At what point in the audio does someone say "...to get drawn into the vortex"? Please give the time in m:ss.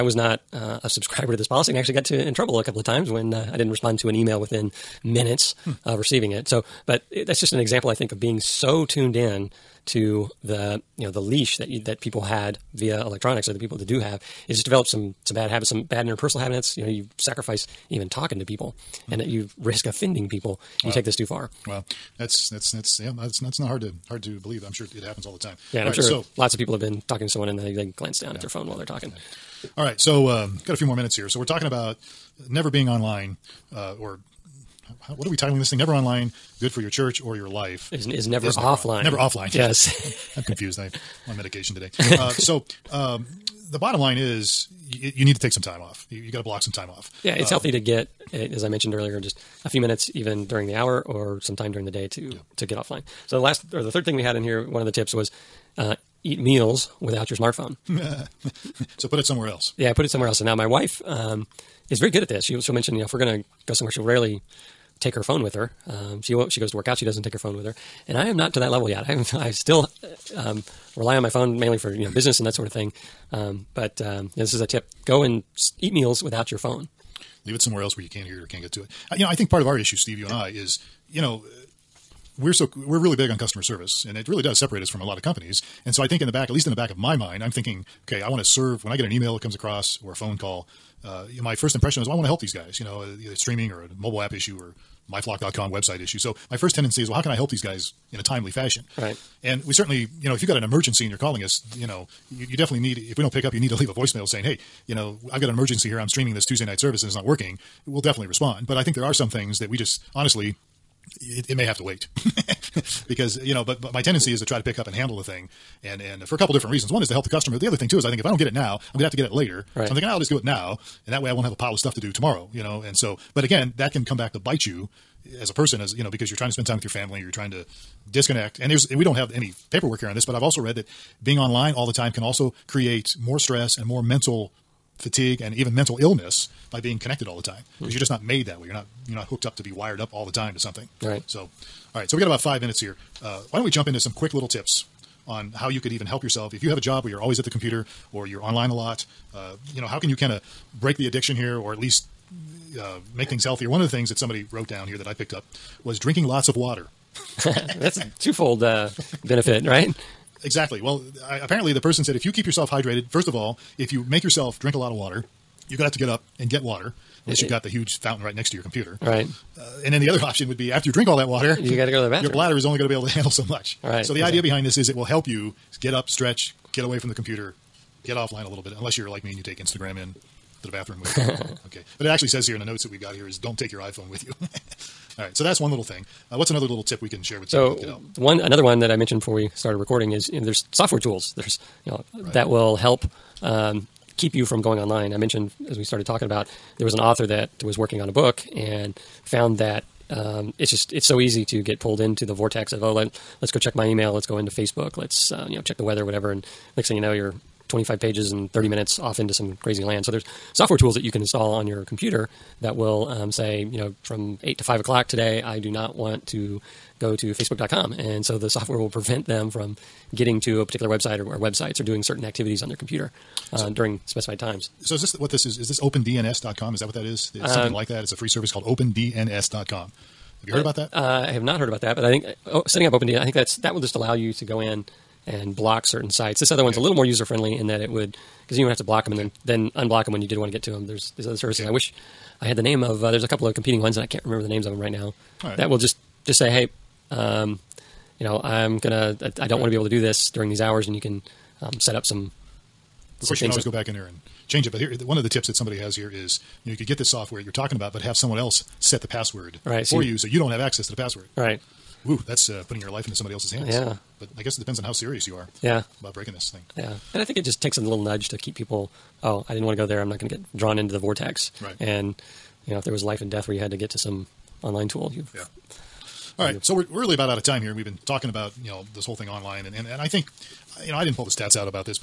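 4:30.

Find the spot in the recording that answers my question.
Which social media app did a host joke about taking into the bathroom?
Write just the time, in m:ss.
2:59.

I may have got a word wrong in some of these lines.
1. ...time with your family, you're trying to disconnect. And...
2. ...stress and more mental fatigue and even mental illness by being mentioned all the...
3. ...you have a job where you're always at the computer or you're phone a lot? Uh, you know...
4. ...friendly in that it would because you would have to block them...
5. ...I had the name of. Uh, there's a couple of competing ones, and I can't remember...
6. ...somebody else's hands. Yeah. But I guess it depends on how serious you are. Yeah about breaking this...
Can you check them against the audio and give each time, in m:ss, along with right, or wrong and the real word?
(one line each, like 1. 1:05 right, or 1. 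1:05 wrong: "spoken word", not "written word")
1. 2:06 right
2. 2:13 wrong: "connected", not "mentioned"
3. 2:26 wrong: "online", not "phone"
4. 3:57 right
5. 4:02 right
6. 4:23 right.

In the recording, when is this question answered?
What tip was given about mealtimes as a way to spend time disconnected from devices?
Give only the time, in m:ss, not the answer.
0:56.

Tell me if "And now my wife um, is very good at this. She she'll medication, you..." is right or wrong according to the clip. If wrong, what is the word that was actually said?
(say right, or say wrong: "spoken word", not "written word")
wrong: "mention", not "medication".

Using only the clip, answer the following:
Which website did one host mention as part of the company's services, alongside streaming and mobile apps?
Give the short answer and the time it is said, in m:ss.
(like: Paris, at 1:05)
myflock.com, at 1:35.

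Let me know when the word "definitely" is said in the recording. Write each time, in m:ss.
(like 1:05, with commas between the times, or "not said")
1:42, 1:48.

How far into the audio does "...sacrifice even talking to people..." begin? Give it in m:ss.
0:17.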